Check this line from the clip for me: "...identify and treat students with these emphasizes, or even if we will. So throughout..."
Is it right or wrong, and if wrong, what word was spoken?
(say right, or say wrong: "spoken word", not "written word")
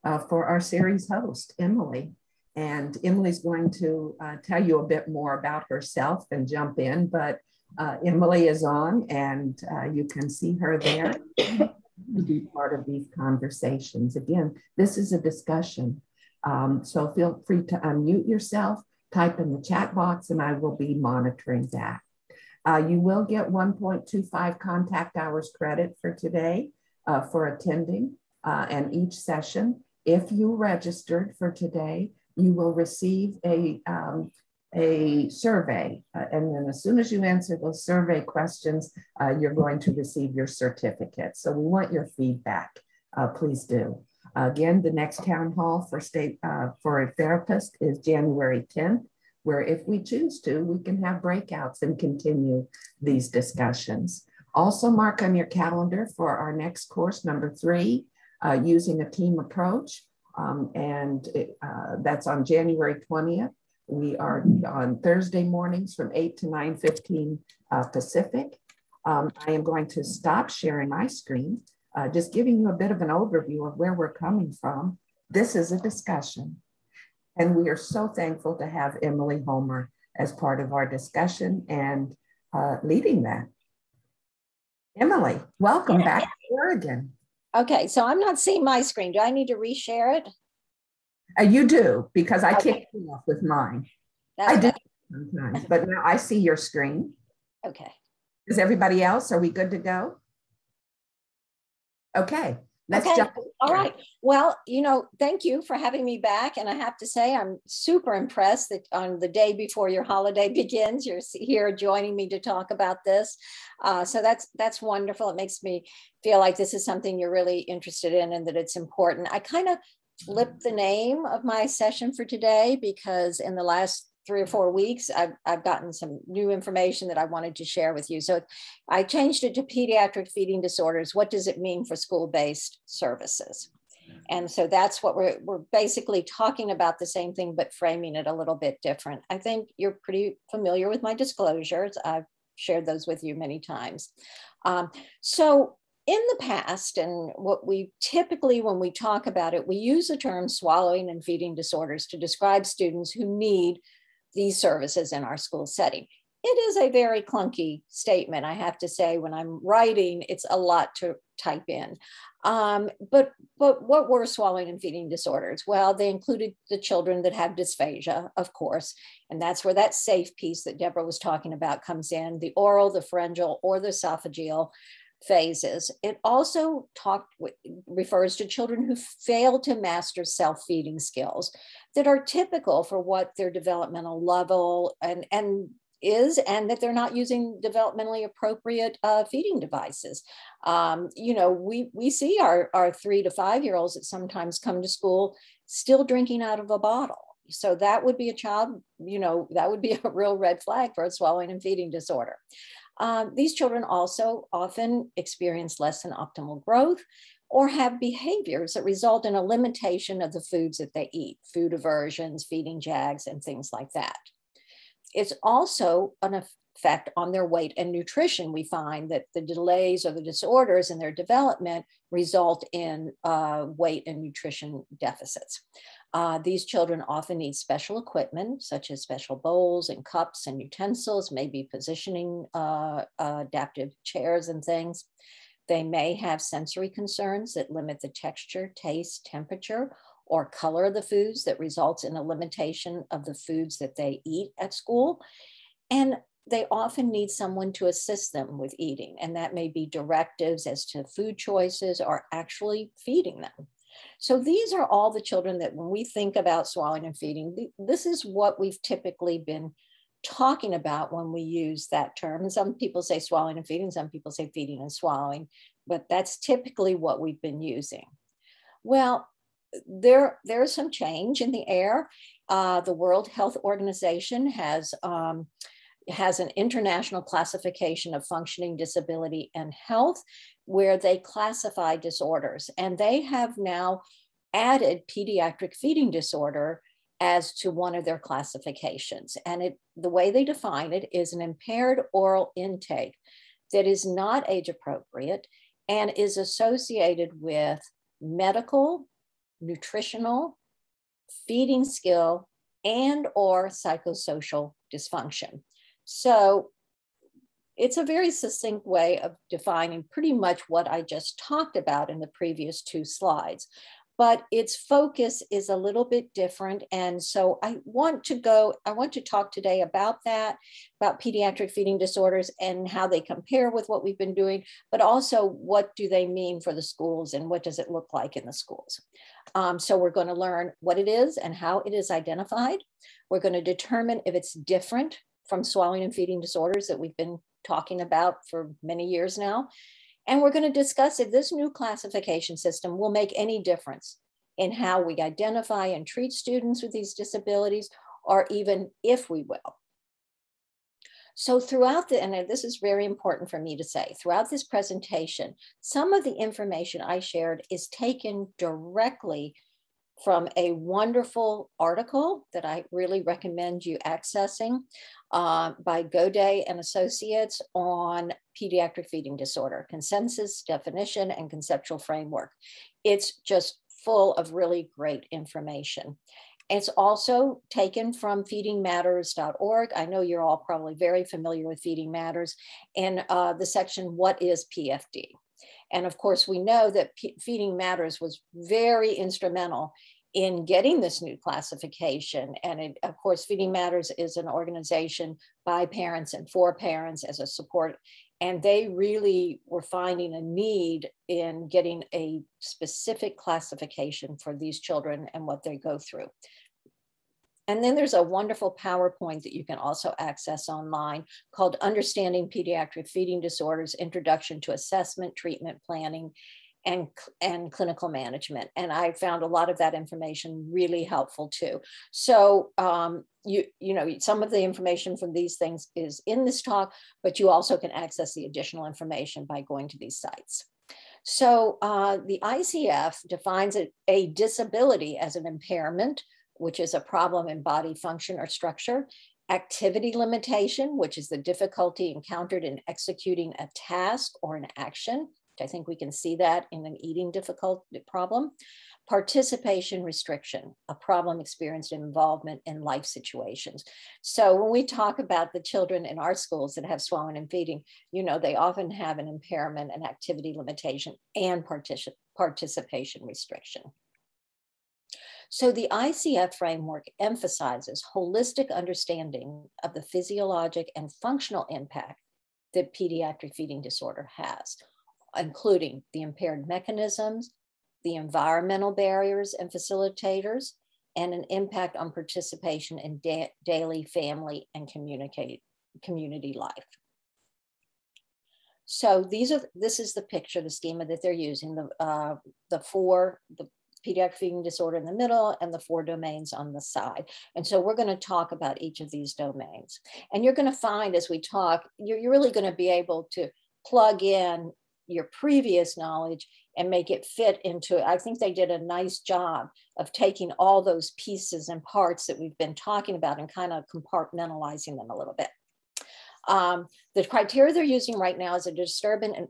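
wrong: "disabilities", not "emphasizes".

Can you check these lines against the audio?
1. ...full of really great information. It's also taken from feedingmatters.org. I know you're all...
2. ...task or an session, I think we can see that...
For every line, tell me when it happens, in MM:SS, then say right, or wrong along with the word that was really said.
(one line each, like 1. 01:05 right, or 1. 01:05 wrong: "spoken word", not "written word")
1. 06:14 right
2. 07:23 wrong: "action", not "session".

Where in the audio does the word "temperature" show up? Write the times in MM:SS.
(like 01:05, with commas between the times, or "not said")
03:59.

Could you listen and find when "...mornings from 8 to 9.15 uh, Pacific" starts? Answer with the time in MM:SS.
01:05.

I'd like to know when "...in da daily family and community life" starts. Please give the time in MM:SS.
08:02.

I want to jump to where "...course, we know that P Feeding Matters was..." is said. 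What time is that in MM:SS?
06:26.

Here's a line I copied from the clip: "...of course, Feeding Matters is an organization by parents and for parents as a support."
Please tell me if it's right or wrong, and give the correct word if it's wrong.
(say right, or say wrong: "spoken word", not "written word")
right.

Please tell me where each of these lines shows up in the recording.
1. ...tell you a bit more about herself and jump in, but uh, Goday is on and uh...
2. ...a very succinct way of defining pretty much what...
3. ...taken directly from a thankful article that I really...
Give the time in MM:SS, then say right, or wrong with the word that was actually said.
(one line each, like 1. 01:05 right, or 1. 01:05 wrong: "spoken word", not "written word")
1. 00:04 wrong: "Emily", not "Goday"
2. 05:07 right
3. 05:57 wrong: "wonderful", not "thankful".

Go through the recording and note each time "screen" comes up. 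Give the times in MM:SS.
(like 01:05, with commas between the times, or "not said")
01:11, 01:28, 01:36.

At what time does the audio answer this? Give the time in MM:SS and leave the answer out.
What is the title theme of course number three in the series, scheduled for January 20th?
00:58.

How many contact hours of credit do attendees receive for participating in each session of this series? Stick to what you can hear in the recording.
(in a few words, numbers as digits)
1.25.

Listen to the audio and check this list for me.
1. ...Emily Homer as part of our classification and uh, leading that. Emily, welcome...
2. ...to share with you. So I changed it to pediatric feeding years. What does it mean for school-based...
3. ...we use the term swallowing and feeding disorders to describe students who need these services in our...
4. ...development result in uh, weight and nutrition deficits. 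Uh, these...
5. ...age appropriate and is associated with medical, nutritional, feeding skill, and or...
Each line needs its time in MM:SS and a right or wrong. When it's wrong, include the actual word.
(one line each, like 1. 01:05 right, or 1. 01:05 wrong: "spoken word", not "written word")
1. 01:19 wrong: "discussion", not "classification"
2. 02:07 wrong: "disorders", not "years"
3. 02:29 right
4. 03:41 right
5. 04:54 right.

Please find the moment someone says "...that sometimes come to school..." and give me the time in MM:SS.
03:13.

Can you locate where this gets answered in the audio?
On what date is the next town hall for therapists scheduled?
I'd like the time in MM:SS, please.
00:47.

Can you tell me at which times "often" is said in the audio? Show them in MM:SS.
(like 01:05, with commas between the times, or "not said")
03:24, 03:47, 04:06, 07:38.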